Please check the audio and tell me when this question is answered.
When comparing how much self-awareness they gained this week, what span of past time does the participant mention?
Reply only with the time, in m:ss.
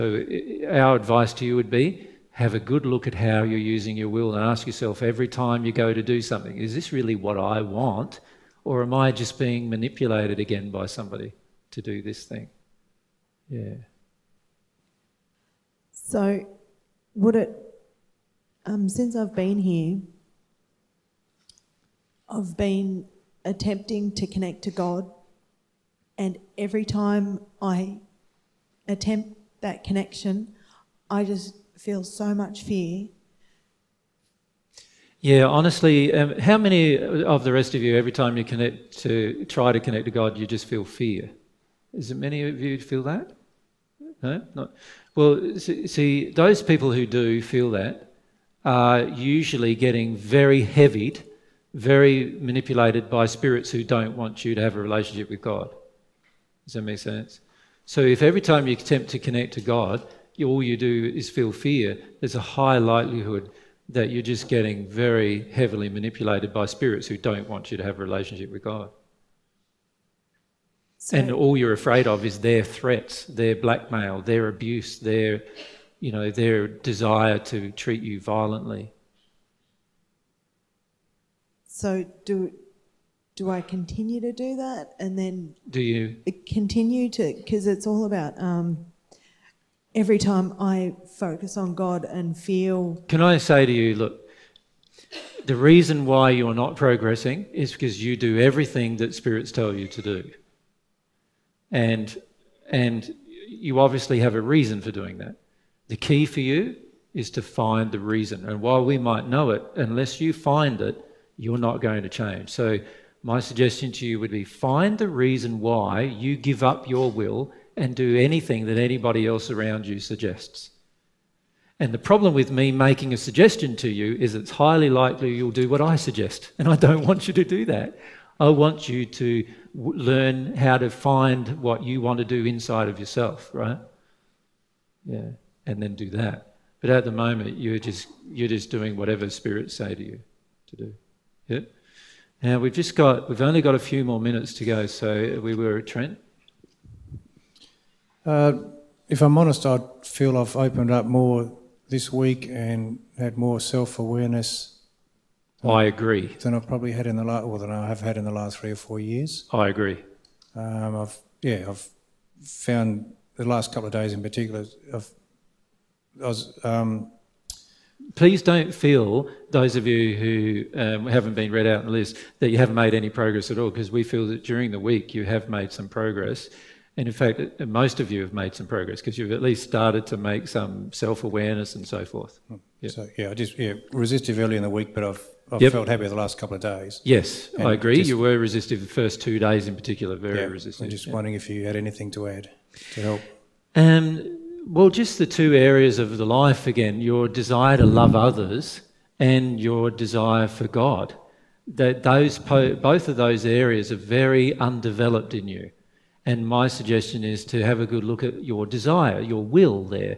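2:38.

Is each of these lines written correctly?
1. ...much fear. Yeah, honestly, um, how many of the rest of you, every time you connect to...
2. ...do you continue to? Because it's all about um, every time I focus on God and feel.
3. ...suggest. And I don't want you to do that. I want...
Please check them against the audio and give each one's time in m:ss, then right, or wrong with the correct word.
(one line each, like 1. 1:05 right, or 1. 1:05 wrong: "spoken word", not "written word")
1. 0:32 right
2. 1:25 right
3. 2:05 right.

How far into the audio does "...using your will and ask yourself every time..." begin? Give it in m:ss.
0:03.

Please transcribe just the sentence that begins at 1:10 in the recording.
So, and all you're afraid of is their threats, their blackmail, their abuse, their, you know, their desire to treat you violently.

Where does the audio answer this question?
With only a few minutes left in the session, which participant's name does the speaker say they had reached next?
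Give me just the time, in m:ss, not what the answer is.
2:25.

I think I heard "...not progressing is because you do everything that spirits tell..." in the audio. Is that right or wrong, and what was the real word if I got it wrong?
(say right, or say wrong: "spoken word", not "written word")
right.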